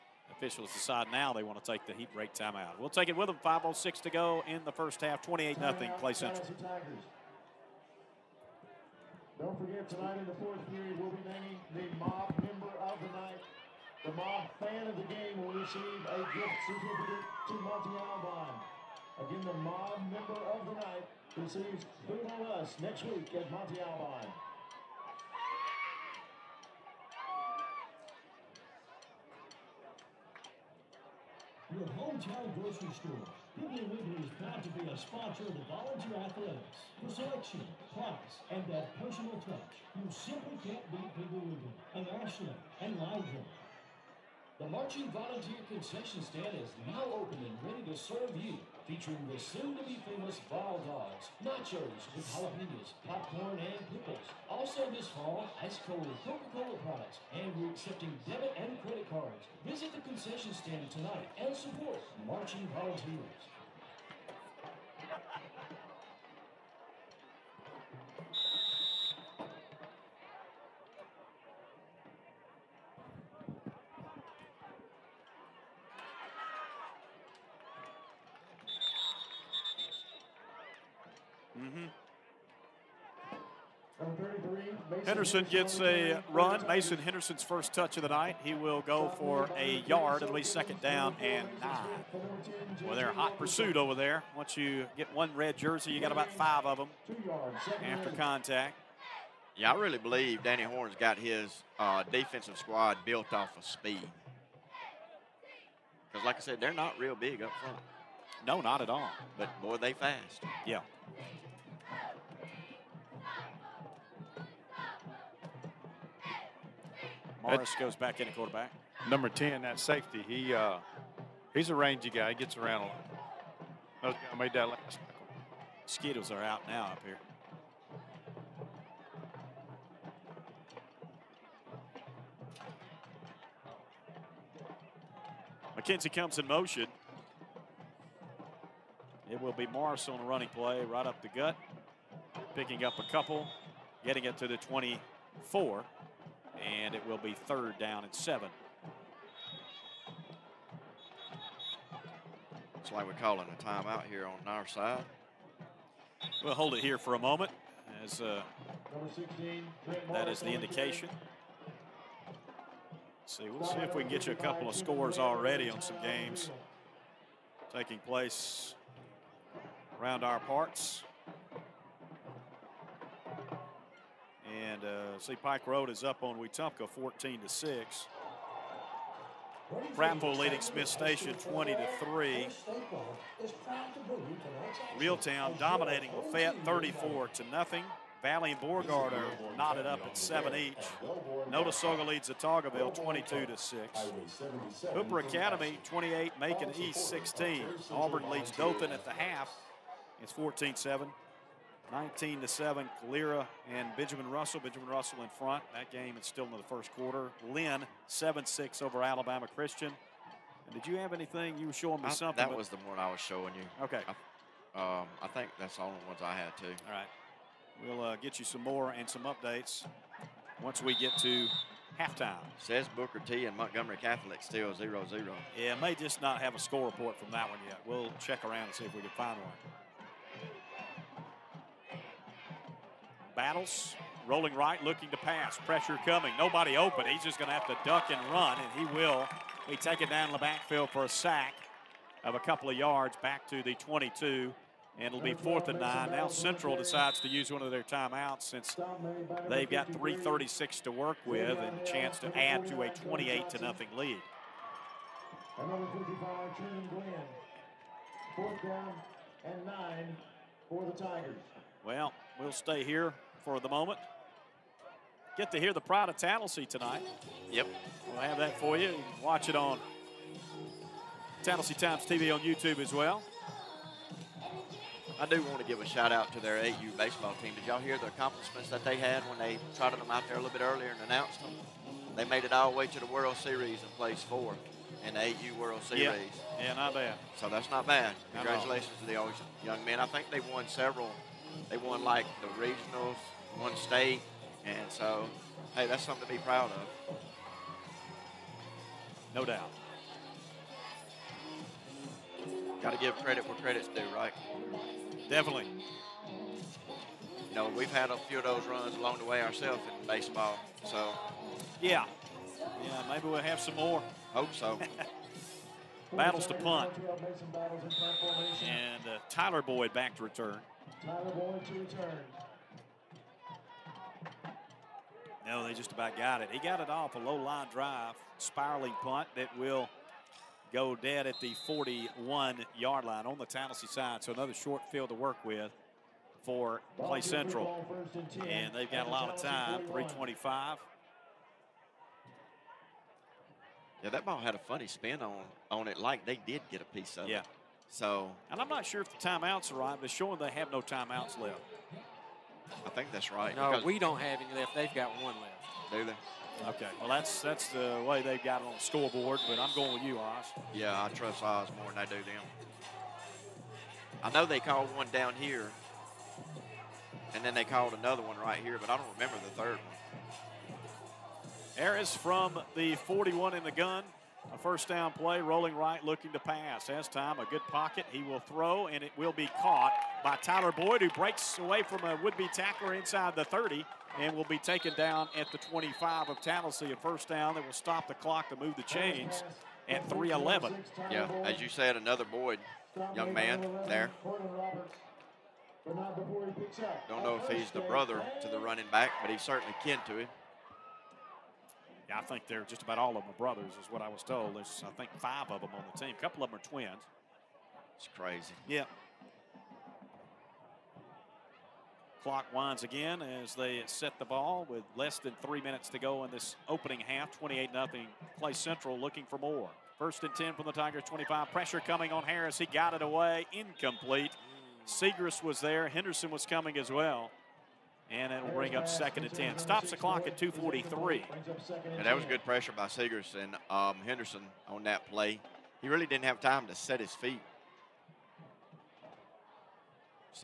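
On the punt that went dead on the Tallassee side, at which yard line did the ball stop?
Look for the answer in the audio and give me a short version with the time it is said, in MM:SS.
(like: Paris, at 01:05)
41, at 05:31.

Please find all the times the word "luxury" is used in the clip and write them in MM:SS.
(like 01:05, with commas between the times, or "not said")
not said.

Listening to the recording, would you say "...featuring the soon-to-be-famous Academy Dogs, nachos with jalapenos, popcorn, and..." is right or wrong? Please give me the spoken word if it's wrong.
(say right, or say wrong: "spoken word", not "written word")
wrong: "Ball", not "Academy".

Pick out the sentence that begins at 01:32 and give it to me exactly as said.
Well, they're hot pursuit over there.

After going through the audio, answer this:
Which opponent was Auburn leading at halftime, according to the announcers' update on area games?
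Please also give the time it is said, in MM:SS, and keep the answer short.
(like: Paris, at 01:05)
Dothan, at 03:18.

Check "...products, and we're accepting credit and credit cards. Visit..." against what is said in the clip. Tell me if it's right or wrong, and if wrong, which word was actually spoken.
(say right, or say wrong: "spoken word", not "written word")
wrong: "debit", not "credit".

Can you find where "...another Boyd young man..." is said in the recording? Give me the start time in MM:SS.
06:31.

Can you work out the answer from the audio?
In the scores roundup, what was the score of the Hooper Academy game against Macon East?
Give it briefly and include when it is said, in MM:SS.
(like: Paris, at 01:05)
28-16, at 03:14.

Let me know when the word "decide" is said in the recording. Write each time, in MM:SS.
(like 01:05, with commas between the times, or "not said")
00:00, 04:06.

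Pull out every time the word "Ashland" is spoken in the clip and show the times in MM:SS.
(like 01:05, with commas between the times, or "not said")
00:42.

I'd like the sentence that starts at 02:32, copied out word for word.
Looks like we're calling a timeout here on our side.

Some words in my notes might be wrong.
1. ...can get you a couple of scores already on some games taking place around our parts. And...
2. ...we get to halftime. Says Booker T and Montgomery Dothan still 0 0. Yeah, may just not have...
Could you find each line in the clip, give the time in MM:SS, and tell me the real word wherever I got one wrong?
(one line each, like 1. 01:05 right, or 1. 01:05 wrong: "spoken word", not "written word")
1. 02:44 right
2. 03:40 wrong: "Catholic", not "Dothan".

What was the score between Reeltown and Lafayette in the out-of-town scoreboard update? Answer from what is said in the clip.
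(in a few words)
34-0.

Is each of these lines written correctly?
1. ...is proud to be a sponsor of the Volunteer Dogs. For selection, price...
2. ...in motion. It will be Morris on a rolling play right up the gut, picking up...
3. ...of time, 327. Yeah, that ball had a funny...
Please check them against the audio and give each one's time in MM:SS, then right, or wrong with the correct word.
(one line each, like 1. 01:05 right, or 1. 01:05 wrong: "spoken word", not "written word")
1. 00:34 wrong: "Athletics", not "Dogs"
2. 02:16 wrong: "running", not "rolling"
3. 05:39 wrong: "325", not "327".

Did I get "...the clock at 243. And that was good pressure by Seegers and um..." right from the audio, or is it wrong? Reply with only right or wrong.
right.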